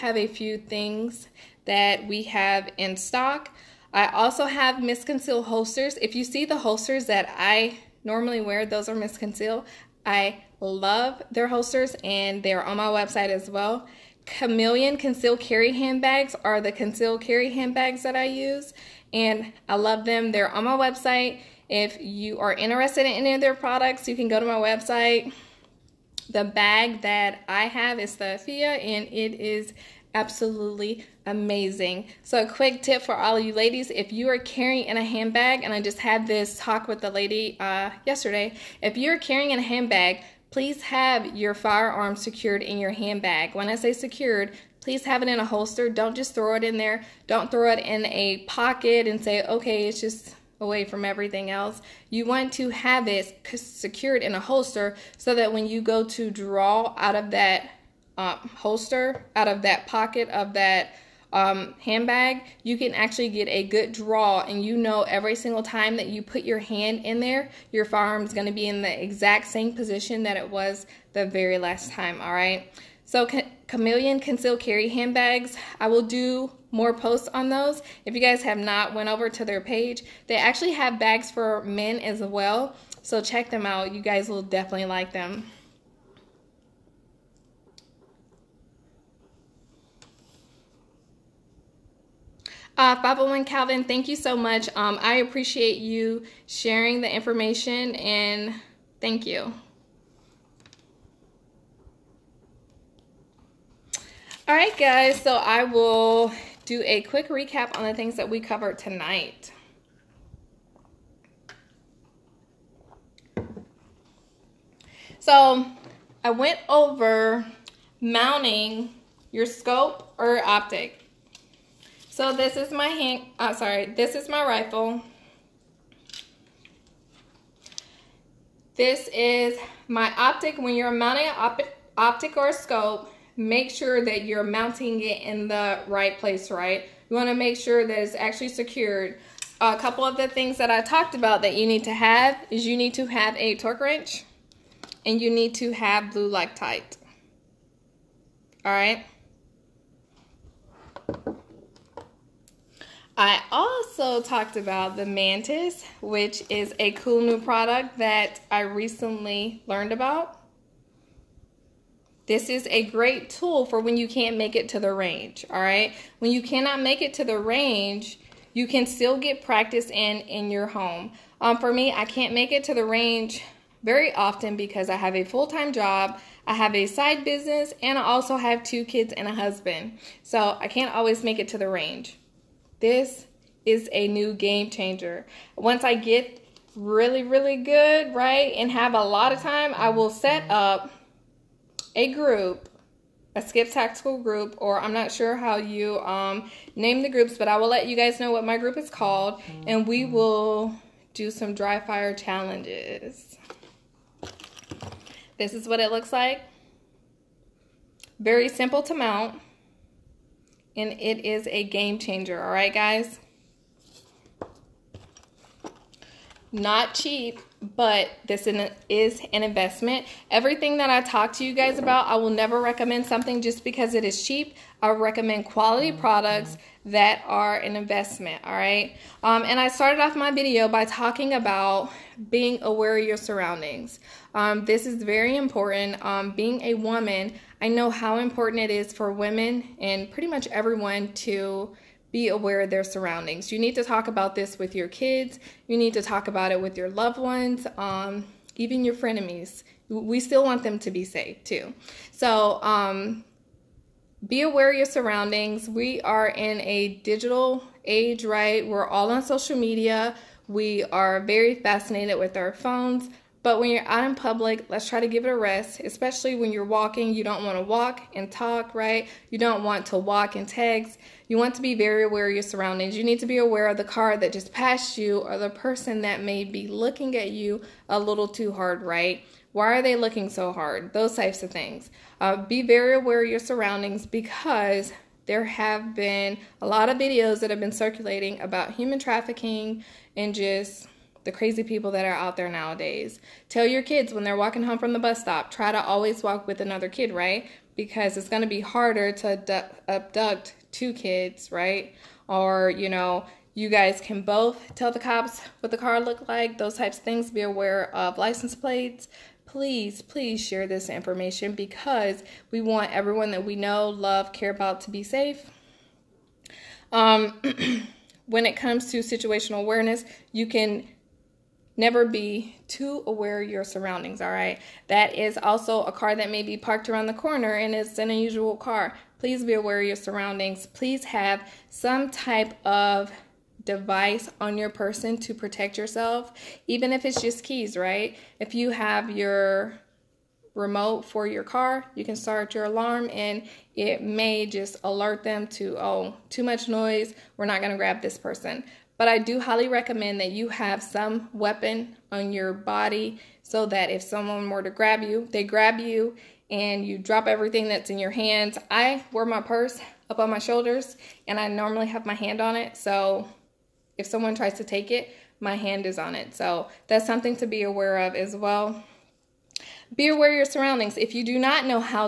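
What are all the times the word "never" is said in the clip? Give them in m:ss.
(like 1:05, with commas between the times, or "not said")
3:42, 5:21.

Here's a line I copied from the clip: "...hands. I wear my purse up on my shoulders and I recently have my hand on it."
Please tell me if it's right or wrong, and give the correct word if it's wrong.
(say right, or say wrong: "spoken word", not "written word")
wrong: "normally", not "recently".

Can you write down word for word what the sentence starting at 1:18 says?
If you guys have not went over to their page, they actually have bags for men as well.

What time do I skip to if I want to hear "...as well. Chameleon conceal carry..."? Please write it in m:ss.
0:13.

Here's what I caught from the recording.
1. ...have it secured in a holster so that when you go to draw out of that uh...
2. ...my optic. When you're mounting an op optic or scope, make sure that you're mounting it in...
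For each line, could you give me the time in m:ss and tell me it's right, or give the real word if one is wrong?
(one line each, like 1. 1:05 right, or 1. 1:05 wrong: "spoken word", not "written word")
1. 0:52 right
2. 2:09 right.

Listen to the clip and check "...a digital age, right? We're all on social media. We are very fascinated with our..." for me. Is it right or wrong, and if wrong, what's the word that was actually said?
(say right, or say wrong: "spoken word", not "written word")
right.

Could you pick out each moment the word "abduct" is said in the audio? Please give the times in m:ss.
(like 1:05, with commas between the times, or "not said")
4:59.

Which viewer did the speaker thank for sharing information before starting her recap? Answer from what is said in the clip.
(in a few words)
501 Calvin.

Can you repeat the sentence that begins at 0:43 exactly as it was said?
When I say secured, please have it in a holster.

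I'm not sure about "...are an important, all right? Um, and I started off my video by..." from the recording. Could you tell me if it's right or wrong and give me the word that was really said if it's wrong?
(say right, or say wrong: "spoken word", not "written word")
wrong: "investment", not "important".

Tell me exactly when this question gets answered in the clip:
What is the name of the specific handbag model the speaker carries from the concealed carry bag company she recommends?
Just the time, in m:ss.
0:28.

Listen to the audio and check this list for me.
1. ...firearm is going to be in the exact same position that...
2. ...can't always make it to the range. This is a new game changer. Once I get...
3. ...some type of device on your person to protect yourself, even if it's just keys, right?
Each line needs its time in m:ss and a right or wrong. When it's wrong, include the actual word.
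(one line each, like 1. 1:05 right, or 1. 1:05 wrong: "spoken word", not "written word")
1. 1:07 right
2. 3:00 right
3. 5:31 right.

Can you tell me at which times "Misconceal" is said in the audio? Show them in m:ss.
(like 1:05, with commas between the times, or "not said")
0:04, 0:08.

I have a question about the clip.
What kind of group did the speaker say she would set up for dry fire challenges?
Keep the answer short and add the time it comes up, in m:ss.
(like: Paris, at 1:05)
skip tactical group, at 3:13.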